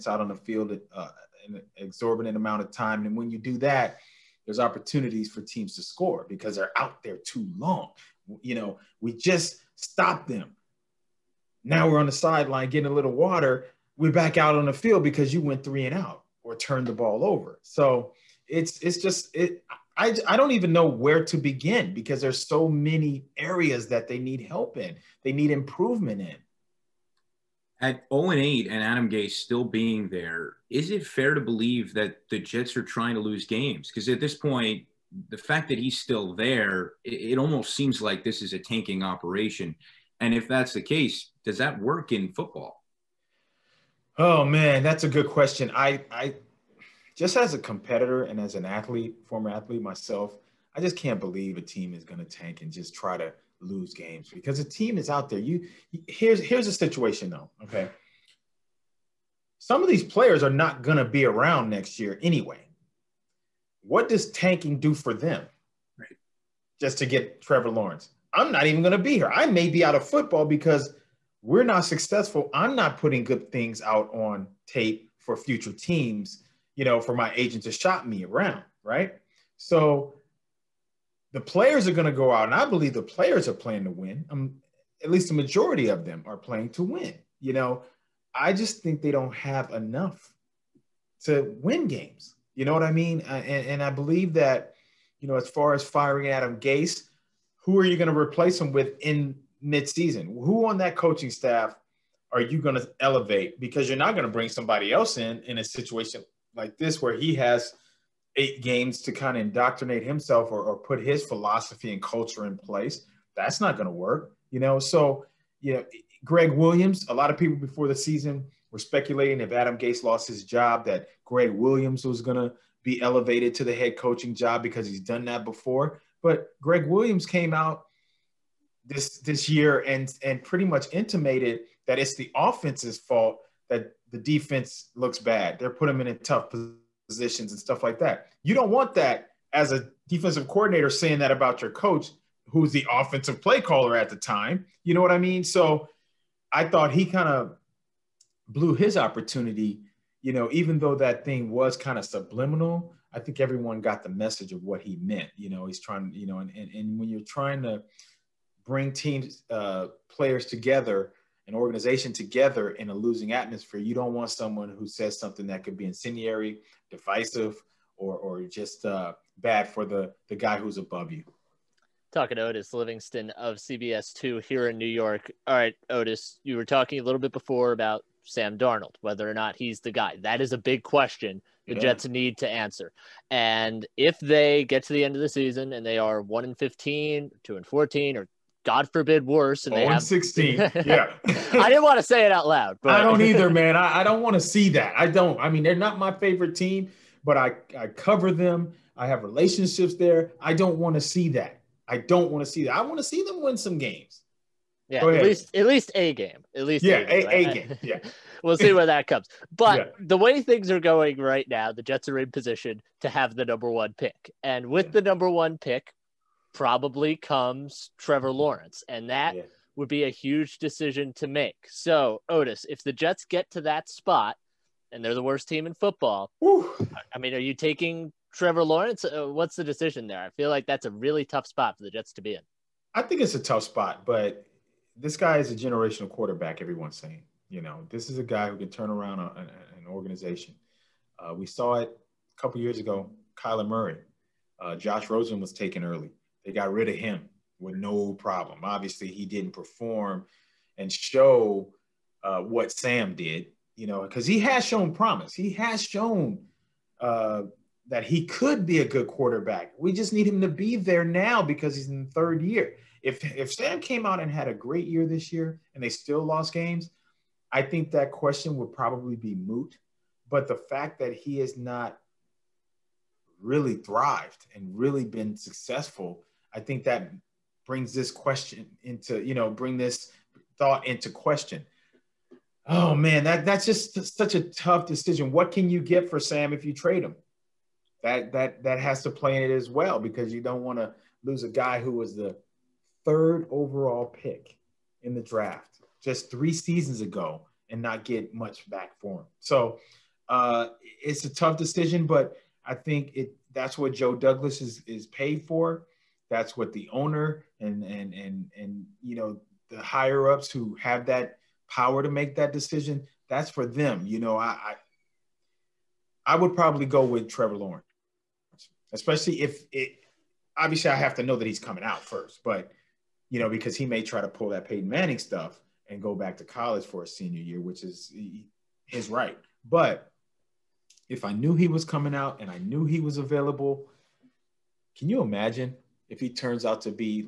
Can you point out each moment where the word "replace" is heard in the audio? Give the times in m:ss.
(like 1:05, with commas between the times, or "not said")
1:38.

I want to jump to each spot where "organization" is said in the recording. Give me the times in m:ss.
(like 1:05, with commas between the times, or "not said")
2:41, 3:59.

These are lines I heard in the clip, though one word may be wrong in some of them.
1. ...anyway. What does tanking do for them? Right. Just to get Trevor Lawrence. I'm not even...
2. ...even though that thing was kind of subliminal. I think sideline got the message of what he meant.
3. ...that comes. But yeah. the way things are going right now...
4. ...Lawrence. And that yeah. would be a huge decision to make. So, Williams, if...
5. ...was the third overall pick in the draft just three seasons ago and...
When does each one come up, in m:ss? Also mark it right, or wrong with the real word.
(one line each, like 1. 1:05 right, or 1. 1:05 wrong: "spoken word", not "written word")
1. 1:02 right
2. 2:30 wrong: "everyone", not "sideline"
3. 3:28 right
4. 3:38 wrong: "Otis", not "Williams"
5. 4:51 right.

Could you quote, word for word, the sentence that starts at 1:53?
That's not going to work, you know.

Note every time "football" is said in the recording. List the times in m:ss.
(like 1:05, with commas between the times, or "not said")
0:42, 1:10, 3:45.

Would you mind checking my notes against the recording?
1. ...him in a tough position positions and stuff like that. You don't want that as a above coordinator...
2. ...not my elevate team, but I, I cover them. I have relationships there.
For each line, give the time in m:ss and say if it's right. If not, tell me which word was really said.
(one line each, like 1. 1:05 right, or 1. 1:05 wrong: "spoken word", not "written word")
1. 2:15 wrong: "defensive", not "above"
2. 3:15 wrong: "favorite", not "elevate".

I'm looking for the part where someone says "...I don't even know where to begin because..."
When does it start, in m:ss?
0:20.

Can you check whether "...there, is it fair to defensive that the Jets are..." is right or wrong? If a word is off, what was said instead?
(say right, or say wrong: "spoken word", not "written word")
wrong: "believe", not "defensive".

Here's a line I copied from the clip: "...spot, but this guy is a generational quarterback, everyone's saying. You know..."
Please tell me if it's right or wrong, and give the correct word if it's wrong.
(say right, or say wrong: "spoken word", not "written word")
right.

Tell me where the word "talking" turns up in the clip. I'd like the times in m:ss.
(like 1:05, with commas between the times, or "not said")
2:52, 2:56.